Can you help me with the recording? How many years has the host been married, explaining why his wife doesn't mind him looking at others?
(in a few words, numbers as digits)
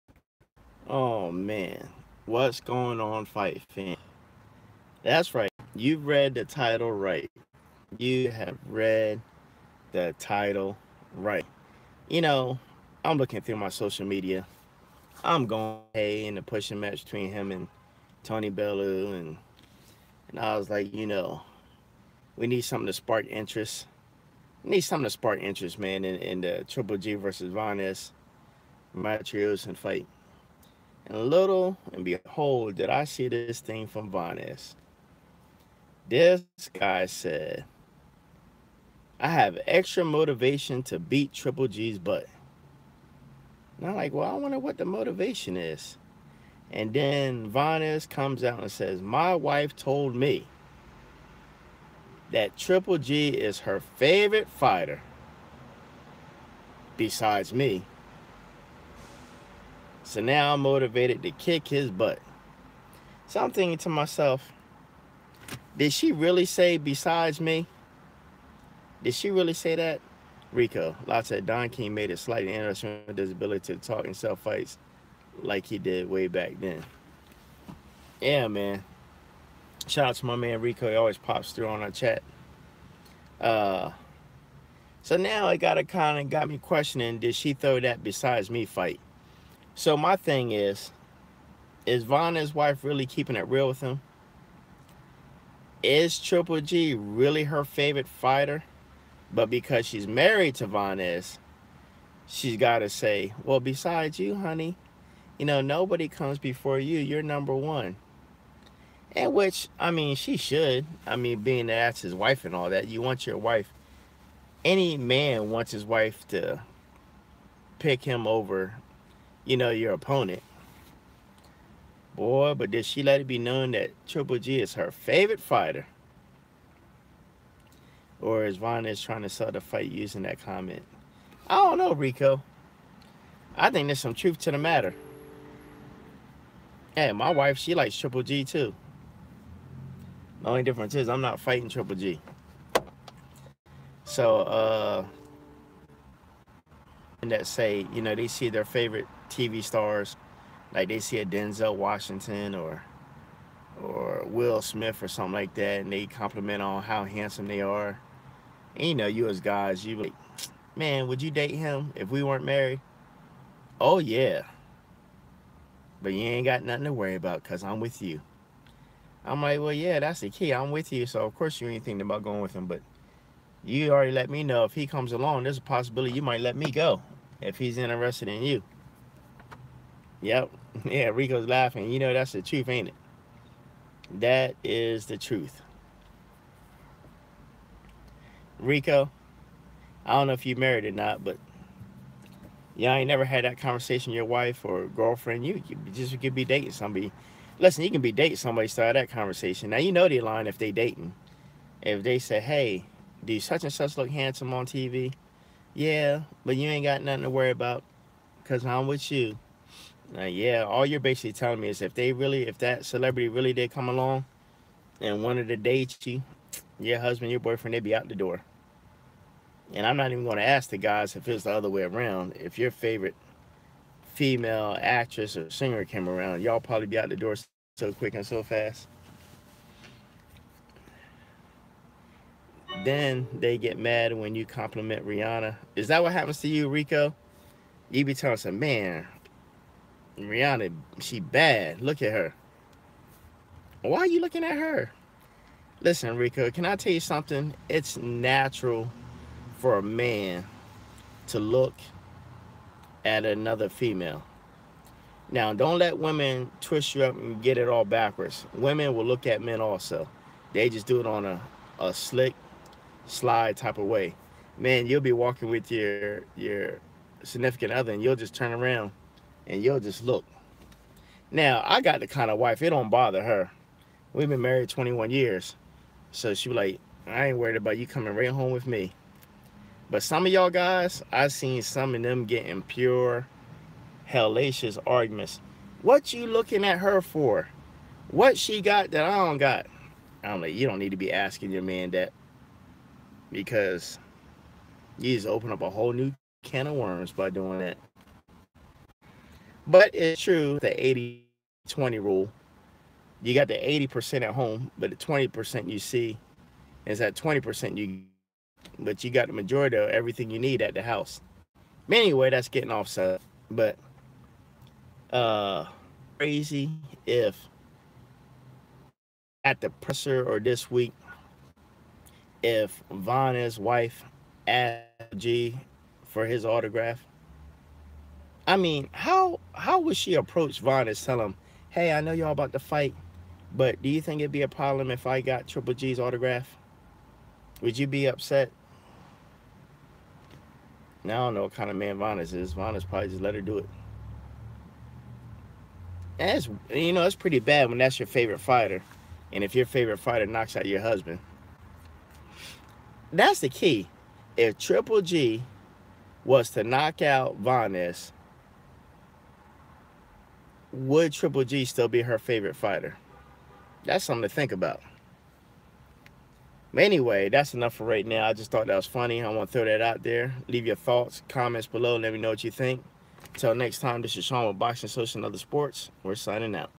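21.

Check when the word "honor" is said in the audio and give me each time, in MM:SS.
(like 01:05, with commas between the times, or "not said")
not said.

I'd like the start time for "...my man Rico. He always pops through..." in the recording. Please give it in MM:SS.
01:20.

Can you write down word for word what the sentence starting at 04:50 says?
I'm like, you don't need to be asking your man that.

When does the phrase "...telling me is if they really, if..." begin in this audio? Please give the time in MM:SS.
03:31.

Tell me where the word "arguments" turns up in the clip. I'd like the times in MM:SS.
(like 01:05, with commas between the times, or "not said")
04:44.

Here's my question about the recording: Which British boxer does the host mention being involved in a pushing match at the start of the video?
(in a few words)
Tony Bellew.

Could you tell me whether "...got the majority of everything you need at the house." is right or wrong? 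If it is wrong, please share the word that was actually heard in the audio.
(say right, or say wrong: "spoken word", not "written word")
right.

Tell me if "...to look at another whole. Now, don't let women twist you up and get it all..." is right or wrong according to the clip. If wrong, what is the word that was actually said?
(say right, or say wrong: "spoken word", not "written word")
wrong: "female", not "whole".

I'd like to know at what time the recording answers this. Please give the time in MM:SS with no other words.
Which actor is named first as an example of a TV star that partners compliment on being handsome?
02:31.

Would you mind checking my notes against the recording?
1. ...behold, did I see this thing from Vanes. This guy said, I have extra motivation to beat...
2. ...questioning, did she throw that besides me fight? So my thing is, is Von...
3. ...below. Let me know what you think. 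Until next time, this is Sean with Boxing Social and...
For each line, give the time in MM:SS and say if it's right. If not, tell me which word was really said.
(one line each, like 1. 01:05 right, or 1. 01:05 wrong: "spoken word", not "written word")
1. 00:32 right
2. 01:26 right
3. 06:11 right.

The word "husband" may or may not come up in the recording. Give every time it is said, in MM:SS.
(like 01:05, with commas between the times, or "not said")
03:36, 05:50.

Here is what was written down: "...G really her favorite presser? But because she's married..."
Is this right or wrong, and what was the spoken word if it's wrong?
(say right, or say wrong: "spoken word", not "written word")
wrong: "fighter", not "presser".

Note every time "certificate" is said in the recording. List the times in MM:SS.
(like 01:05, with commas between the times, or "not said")
not said.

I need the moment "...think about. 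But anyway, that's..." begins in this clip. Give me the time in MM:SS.
06:04.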